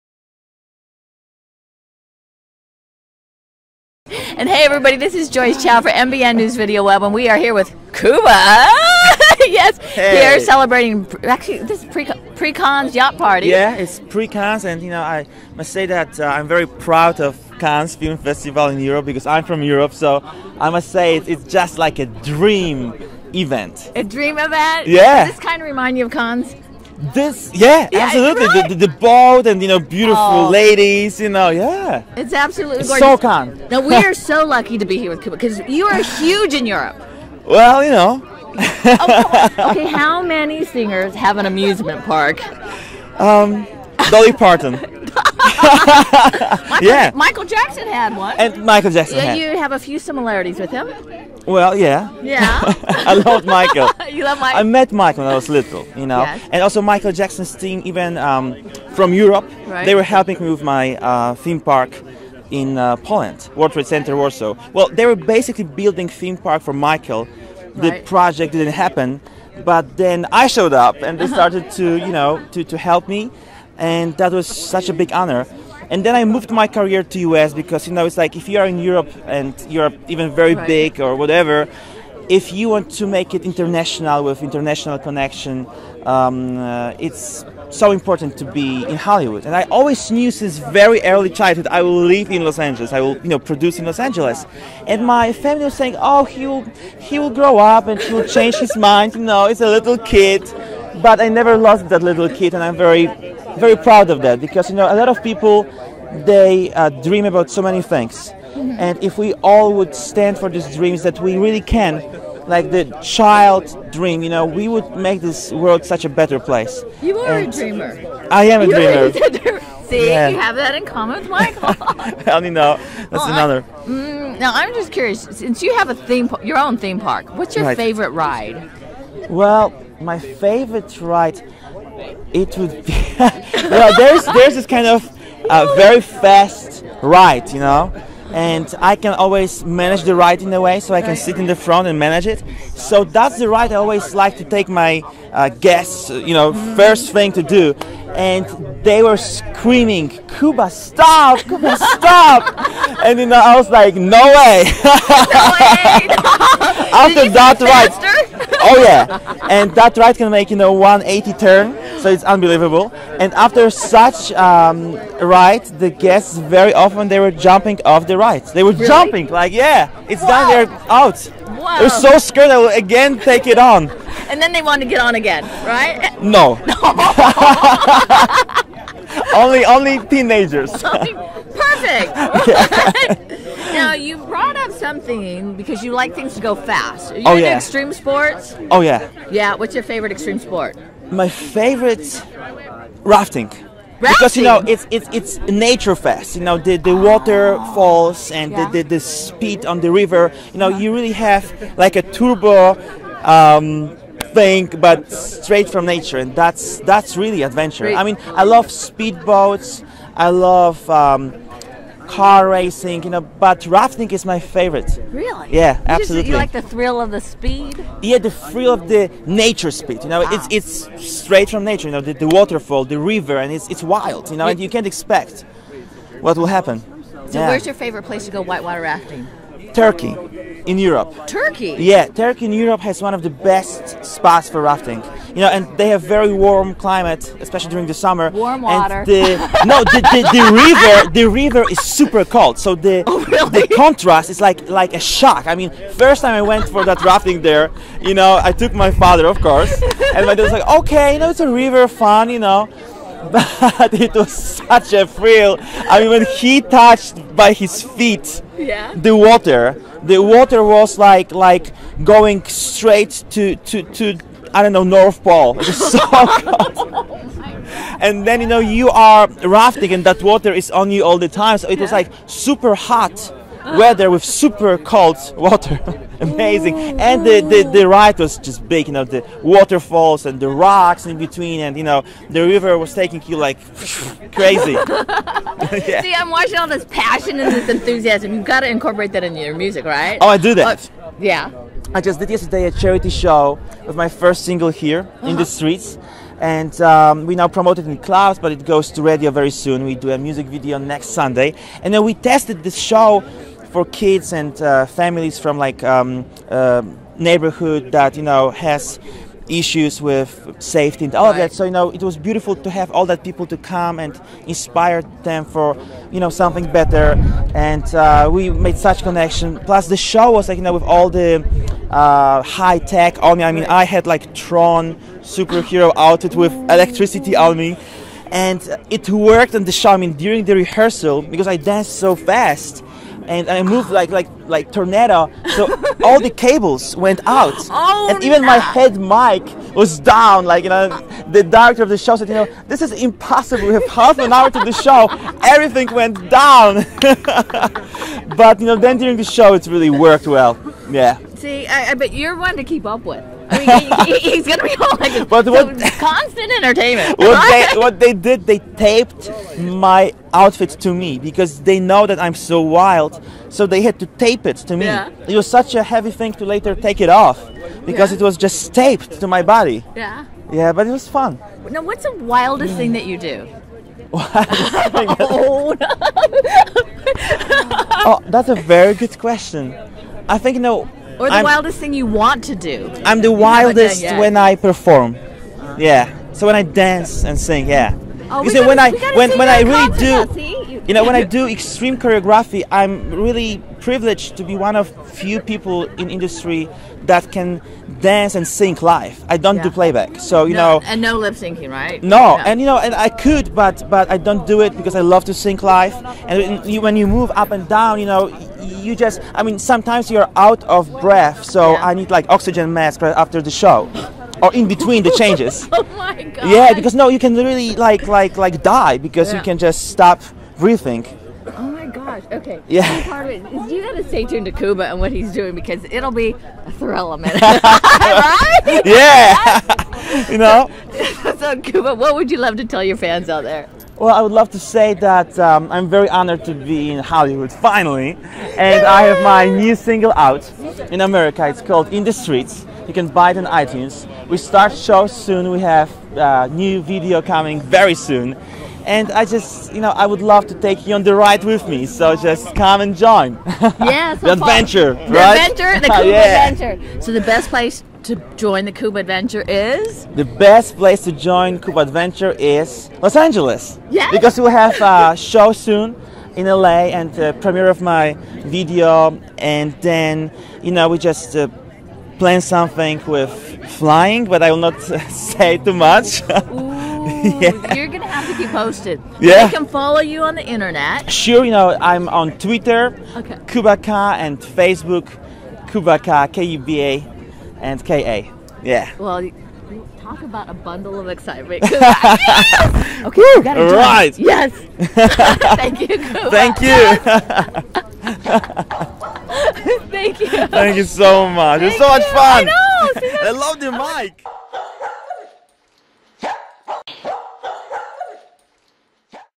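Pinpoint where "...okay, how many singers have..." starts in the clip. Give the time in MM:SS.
00:39.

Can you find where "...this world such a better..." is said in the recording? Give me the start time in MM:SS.
01:55.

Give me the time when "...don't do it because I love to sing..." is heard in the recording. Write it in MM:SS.
06:44.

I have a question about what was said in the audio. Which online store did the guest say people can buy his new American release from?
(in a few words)
iTunes.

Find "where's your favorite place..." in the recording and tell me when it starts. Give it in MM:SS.
03:47.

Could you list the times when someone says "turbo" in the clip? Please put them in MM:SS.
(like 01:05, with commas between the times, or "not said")
03:22.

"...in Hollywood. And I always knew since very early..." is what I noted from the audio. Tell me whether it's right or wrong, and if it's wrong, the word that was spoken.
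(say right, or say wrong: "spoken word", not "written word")
right.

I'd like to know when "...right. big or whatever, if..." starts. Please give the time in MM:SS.
01:20.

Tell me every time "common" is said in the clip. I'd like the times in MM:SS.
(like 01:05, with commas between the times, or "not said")
02:00.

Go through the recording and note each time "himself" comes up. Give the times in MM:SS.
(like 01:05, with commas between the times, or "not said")
not said.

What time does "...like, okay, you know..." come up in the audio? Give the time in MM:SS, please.
04:10.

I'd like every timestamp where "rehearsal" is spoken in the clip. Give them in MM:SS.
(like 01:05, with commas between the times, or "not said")
05:30.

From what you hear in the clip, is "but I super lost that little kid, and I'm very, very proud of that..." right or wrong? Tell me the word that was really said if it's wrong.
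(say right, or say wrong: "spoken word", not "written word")
wrong: "never", not "super".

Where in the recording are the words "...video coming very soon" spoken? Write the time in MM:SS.
07:26.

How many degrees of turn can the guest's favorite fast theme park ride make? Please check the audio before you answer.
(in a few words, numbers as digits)
180.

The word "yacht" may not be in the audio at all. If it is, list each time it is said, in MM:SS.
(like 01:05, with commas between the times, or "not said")
00:12.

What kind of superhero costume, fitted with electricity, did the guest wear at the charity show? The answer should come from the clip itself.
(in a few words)
Tron.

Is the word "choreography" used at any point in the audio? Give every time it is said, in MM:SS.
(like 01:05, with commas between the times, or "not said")
06:31.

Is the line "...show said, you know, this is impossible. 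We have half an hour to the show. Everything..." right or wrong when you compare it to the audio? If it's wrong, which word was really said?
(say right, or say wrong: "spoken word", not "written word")
right.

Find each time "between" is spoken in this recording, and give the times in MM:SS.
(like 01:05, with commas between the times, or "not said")
04:41, 06:54.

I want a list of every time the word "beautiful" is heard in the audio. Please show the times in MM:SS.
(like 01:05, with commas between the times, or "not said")
00:29, 05:12.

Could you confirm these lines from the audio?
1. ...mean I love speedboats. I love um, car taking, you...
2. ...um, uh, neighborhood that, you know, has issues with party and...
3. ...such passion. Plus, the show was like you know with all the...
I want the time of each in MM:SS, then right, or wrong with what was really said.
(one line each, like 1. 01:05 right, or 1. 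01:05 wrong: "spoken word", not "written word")
1. 03:28 wrong: "racing", not "taking"
2. 05:05 wrong: "safety", not "party"
3. 05:18 wrong: "connection", not "passion".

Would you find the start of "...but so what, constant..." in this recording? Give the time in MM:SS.
05:55.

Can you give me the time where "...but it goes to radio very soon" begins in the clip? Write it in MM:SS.
04:58.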